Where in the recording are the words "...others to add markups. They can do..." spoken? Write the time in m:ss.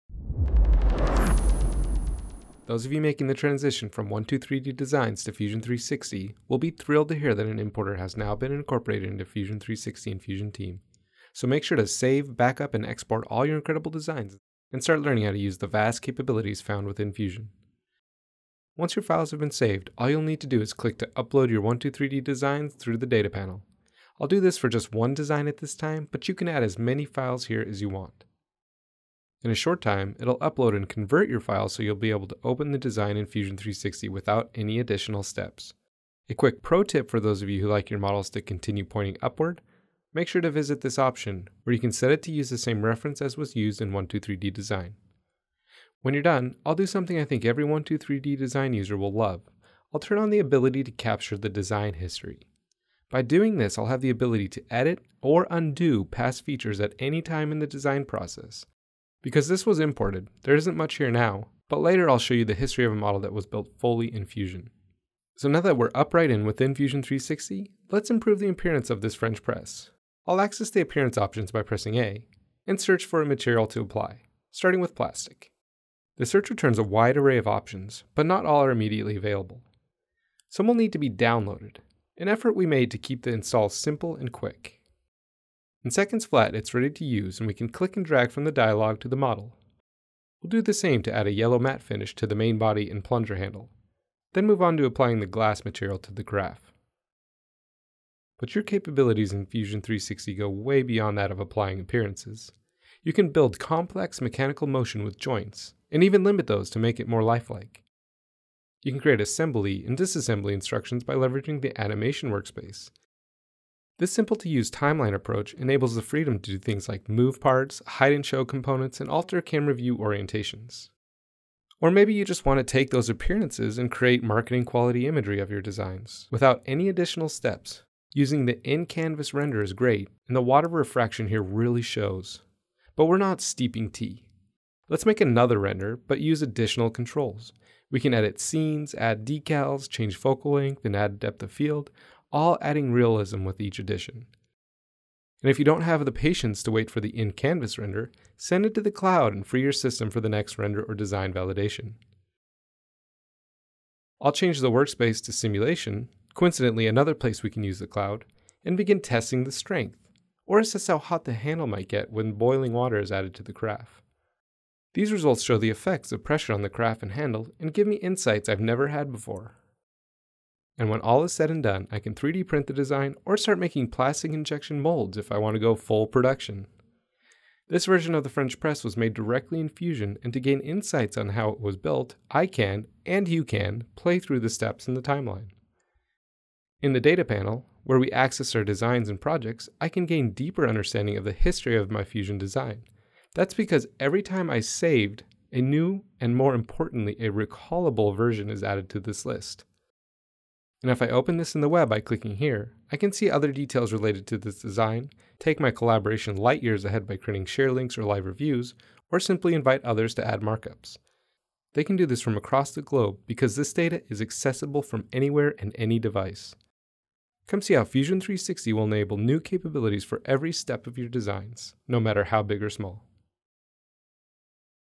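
3:29.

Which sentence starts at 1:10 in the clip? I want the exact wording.
I'll access the appearance options by pressing A, and search for a material to apply, starting with plastic.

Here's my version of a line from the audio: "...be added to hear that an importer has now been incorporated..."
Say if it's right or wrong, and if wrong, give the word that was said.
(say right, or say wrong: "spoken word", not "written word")
wrong: "thrilled", not "added".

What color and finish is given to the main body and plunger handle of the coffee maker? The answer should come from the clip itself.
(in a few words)
yellow matte.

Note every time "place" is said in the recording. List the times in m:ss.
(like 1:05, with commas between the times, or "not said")
2:37.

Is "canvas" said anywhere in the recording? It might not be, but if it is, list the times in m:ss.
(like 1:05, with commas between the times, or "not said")
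2:08, 2:27.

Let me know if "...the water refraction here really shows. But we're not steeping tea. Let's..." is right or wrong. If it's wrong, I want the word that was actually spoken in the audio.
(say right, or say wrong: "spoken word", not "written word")
right.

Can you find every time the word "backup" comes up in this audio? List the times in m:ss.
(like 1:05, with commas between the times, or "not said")
0:12.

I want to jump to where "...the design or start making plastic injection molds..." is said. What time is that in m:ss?
2:52.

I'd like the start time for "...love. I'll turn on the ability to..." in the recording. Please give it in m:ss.
0:49.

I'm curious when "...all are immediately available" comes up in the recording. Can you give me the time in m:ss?
1:18.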